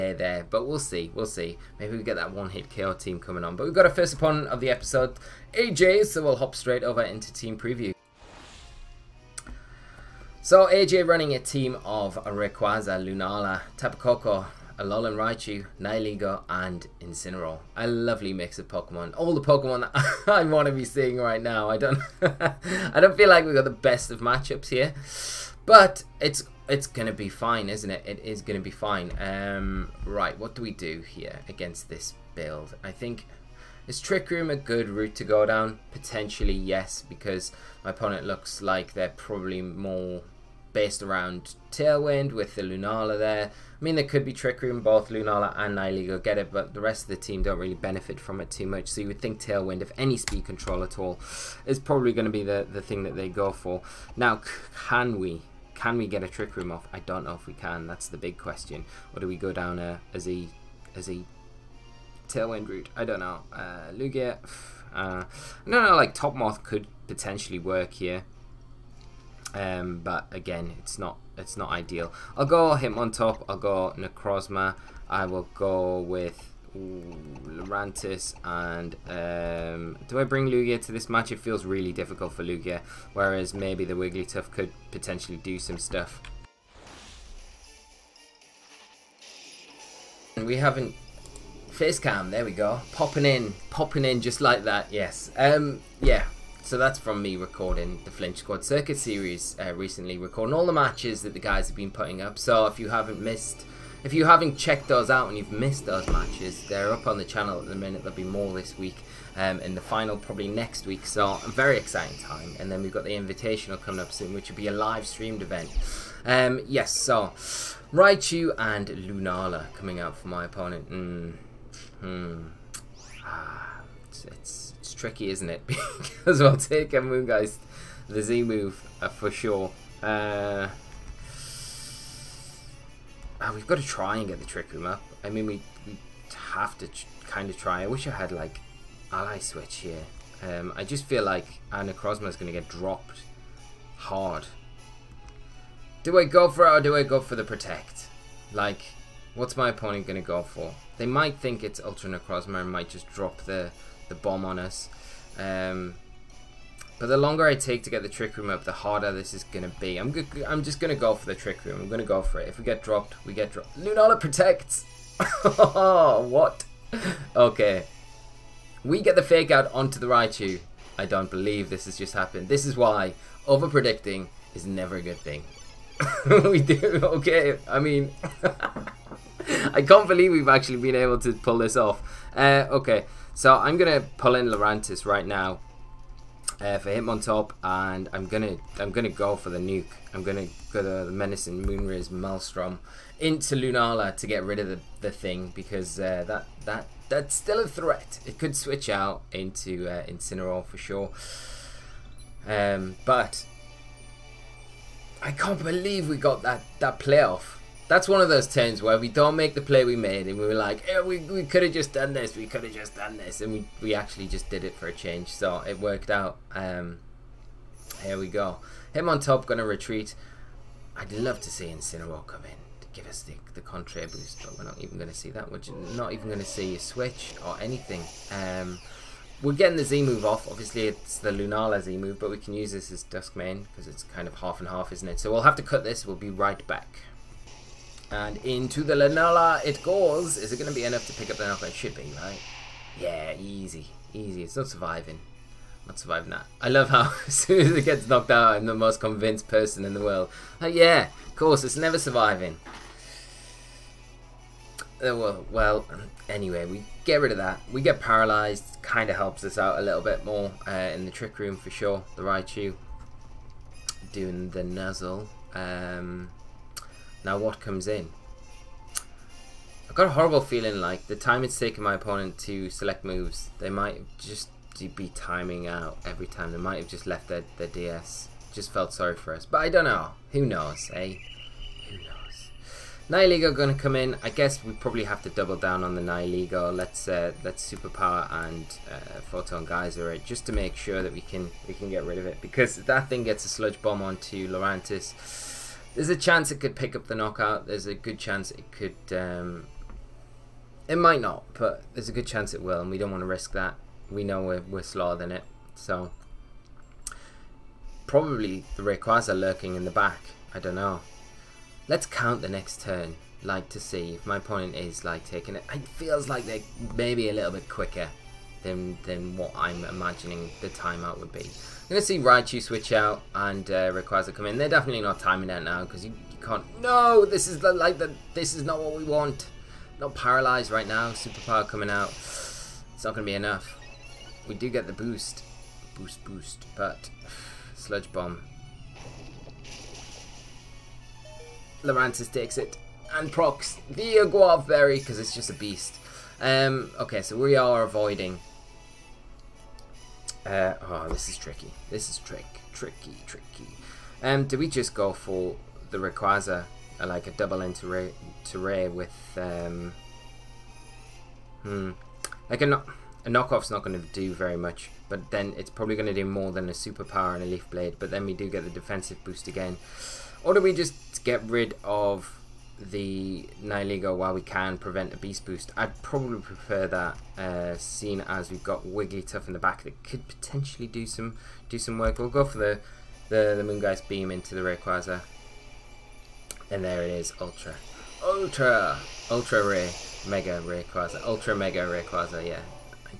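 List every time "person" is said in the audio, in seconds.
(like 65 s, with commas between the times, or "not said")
249 s.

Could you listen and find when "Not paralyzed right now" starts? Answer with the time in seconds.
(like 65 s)
329 s.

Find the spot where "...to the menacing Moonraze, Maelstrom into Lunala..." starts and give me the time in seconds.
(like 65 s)
190 s.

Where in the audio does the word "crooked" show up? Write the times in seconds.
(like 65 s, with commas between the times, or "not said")
not said.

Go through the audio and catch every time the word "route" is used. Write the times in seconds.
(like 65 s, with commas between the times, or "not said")
34 s, 62 s.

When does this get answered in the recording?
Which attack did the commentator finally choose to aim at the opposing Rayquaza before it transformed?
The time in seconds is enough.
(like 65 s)
383 s.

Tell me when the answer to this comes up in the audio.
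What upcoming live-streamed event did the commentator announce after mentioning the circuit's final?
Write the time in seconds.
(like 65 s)
113 s.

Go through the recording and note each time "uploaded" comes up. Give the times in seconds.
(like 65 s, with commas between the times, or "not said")
not said.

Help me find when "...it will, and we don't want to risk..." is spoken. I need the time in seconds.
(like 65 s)
302 s.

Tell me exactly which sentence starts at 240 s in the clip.
Is it going to be enough to pick up the Nalpa?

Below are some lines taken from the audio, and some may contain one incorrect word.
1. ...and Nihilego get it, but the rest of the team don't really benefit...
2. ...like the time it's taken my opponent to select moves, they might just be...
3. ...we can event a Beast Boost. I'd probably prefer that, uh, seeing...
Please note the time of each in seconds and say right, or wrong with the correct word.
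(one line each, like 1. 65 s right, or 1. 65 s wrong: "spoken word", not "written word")
1. 45 s right
2. 270 s right
3. 374 s wrong: "prevent", not "event".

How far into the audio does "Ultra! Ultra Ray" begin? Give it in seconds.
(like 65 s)
388 s.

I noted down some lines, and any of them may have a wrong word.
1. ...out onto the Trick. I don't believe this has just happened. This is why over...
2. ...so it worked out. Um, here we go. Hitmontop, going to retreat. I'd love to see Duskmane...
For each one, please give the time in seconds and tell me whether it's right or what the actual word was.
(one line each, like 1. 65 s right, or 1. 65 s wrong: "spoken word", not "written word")
1. 169 s wrong: "Raichu", not "Trick"
2. 215 s wrong: "Incineroar", not "Duskmane".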